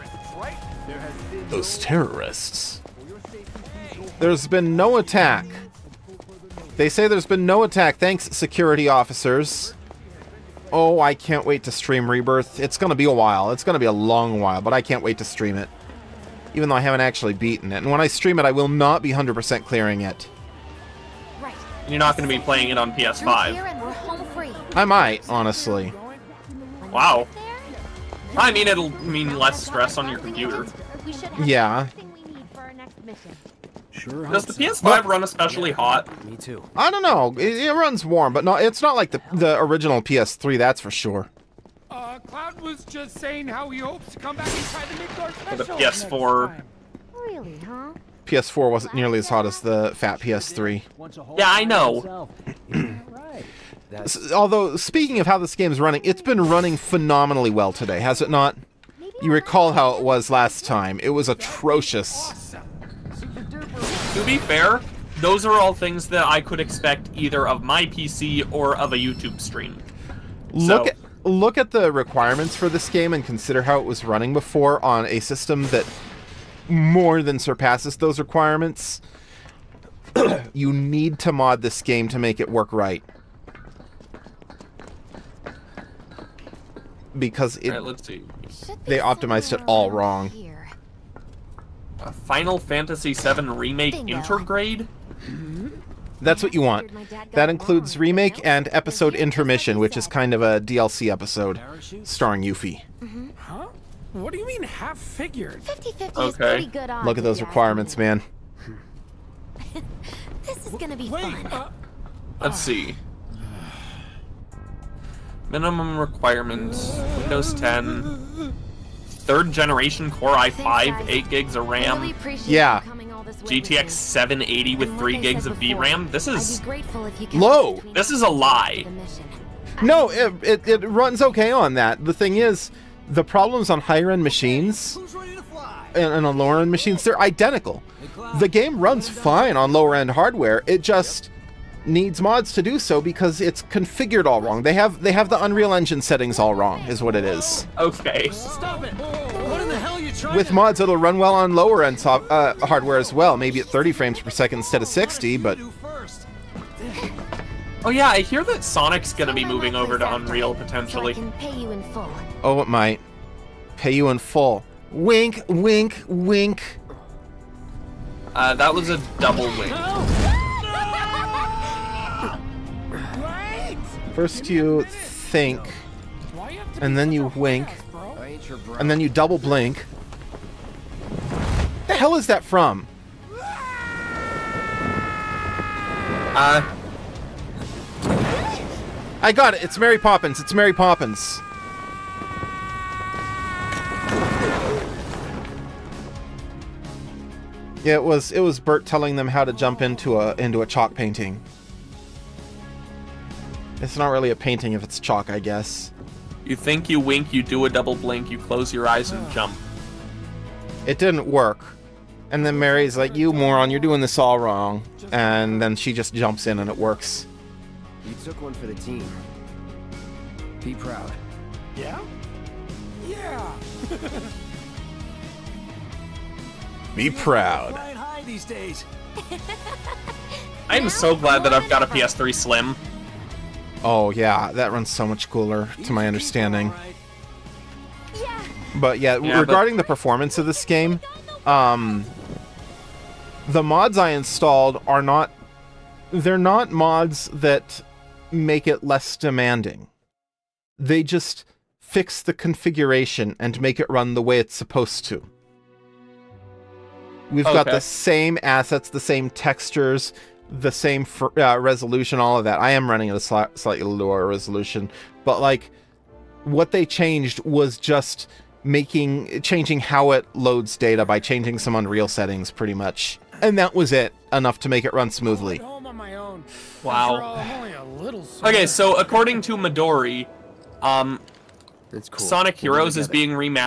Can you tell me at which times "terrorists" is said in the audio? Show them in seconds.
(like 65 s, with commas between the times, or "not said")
1 s.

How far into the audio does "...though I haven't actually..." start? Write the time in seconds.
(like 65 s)
16 s.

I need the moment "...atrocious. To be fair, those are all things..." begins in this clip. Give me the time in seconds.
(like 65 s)
61 s.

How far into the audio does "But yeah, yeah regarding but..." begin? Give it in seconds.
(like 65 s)
238 s.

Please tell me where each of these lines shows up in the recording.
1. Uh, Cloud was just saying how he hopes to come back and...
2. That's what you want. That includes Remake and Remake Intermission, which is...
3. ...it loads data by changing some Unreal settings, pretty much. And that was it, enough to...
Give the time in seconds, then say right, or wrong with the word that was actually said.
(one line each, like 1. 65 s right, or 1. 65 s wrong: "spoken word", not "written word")
1. 41 s right
2. 96 s wrong: "Episode", not "Remake"
3. 270 s right.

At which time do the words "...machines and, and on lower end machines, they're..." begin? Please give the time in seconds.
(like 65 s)
134 s.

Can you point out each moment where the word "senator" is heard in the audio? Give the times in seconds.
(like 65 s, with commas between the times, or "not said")
not said.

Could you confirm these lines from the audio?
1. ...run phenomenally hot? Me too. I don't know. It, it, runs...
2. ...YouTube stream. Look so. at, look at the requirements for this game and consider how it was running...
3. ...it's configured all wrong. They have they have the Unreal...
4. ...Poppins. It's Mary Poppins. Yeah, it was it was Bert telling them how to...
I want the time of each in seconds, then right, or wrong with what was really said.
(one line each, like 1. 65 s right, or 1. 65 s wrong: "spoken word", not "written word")
1. 35 s wrong: "especially", not "phenomenally"
2. 68 s right
3. 143 s right
4. 189 s right.